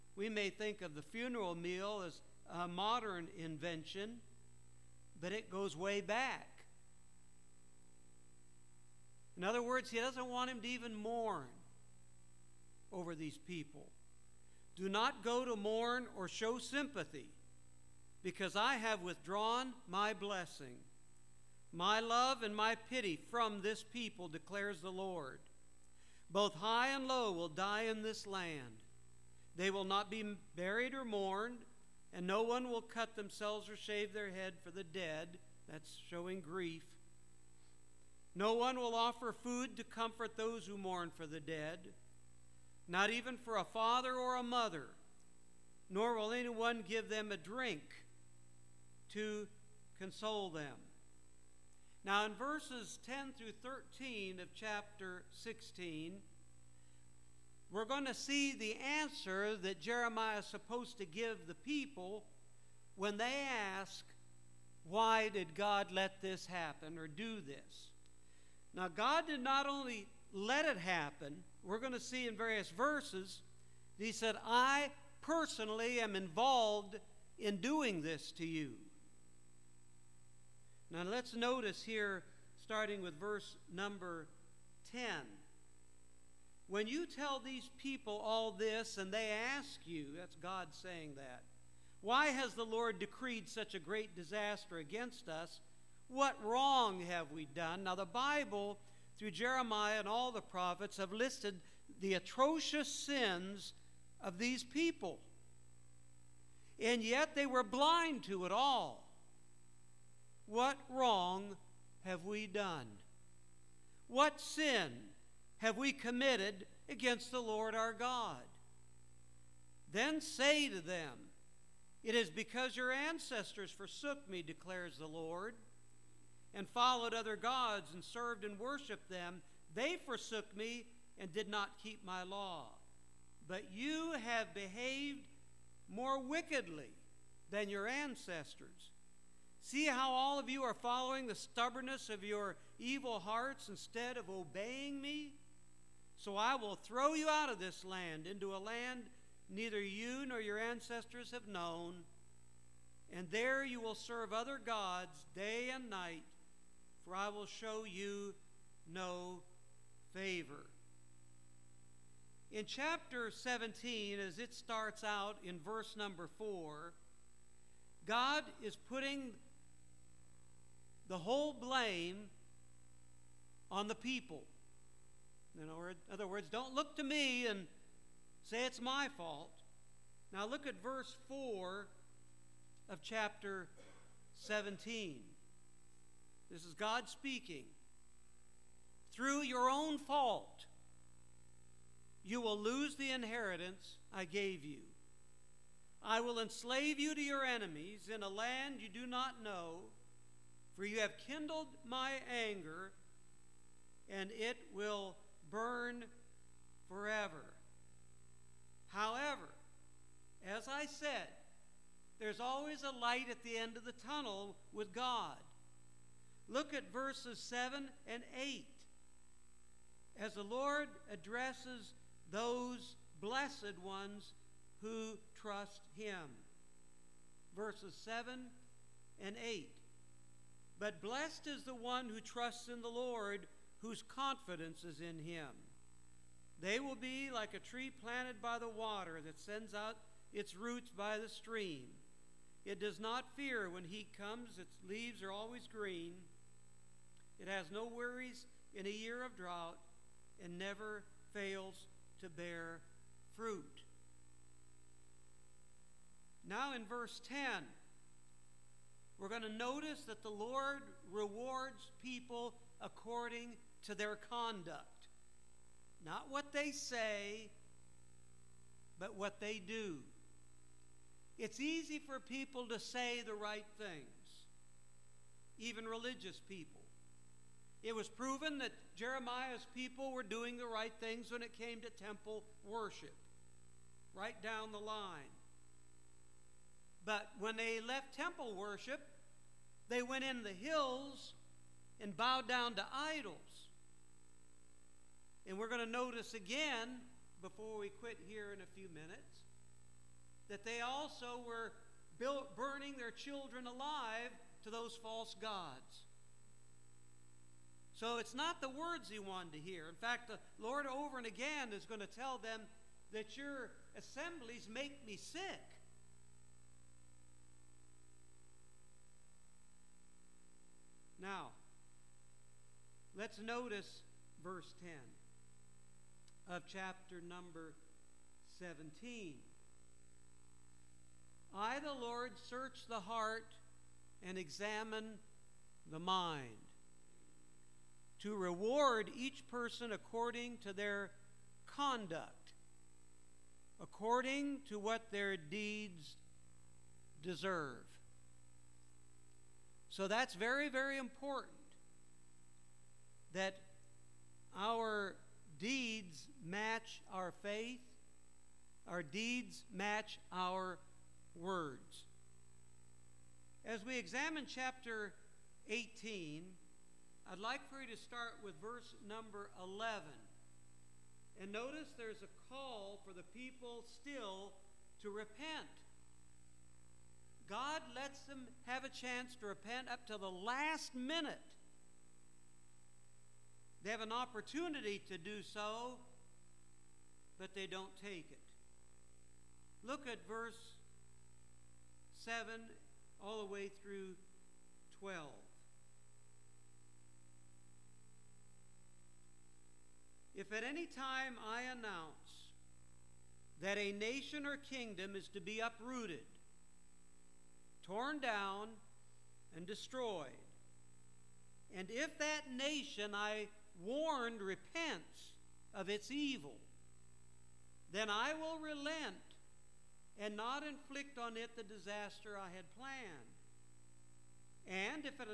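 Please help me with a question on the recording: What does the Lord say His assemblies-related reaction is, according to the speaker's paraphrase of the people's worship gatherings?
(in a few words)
Make me sick.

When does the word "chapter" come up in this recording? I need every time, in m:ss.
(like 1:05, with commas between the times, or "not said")
0:54, 2:42, 3:03, 5:26, 6:04.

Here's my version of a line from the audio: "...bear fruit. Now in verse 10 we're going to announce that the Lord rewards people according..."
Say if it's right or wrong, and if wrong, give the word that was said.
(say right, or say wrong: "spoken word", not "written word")
wrong: "notice", not "announce".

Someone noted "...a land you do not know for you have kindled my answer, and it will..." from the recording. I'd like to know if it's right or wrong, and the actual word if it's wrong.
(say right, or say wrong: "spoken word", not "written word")
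wrong: "anger", not "answer".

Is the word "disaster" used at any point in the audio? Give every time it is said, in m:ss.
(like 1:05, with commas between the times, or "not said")
1:34, 7:01.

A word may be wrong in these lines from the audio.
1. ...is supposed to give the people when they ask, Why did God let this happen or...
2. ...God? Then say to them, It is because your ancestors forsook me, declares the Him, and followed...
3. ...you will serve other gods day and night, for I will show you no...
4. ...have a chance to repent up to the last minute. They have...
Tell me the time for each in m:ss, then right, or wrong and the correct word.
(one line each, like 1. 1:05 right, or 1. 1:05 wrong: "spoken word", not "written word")
1. 1:00 right
2. 1:57 wrong: "Lord", not "Him"
3. 2:33 right
4. 6:18 right.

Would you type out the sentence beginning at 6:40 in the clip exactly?
If at any time I announce that a nation or kingdom is to be uprooted, torn down and destroyed.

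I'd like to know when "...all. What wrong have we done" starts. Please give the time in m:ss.
1:48.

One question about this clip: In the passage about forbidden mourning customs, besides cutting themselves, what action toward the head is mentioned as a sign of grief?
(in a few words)
Shave their head.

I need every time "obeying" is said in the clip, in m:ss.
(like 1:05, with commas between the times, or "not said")
2:24.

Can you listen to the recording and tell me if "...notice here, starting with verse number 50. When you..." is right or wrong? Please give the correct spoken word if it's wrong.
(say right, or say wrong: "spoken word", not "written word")
wrong: "10", not "50".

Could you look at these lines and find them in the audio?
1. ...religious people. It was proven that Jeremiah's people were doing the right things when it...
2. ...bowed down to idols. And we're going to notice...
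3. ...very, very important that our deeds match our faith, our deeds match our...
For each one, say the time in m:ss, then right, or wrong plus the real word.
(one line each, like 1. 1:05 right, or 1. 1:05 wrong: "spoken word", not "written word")
1. 4:35 right
2. 4:52 right
3. 5:50 right.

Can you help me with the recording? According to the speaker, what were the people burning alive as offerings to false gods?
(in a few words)
Their children.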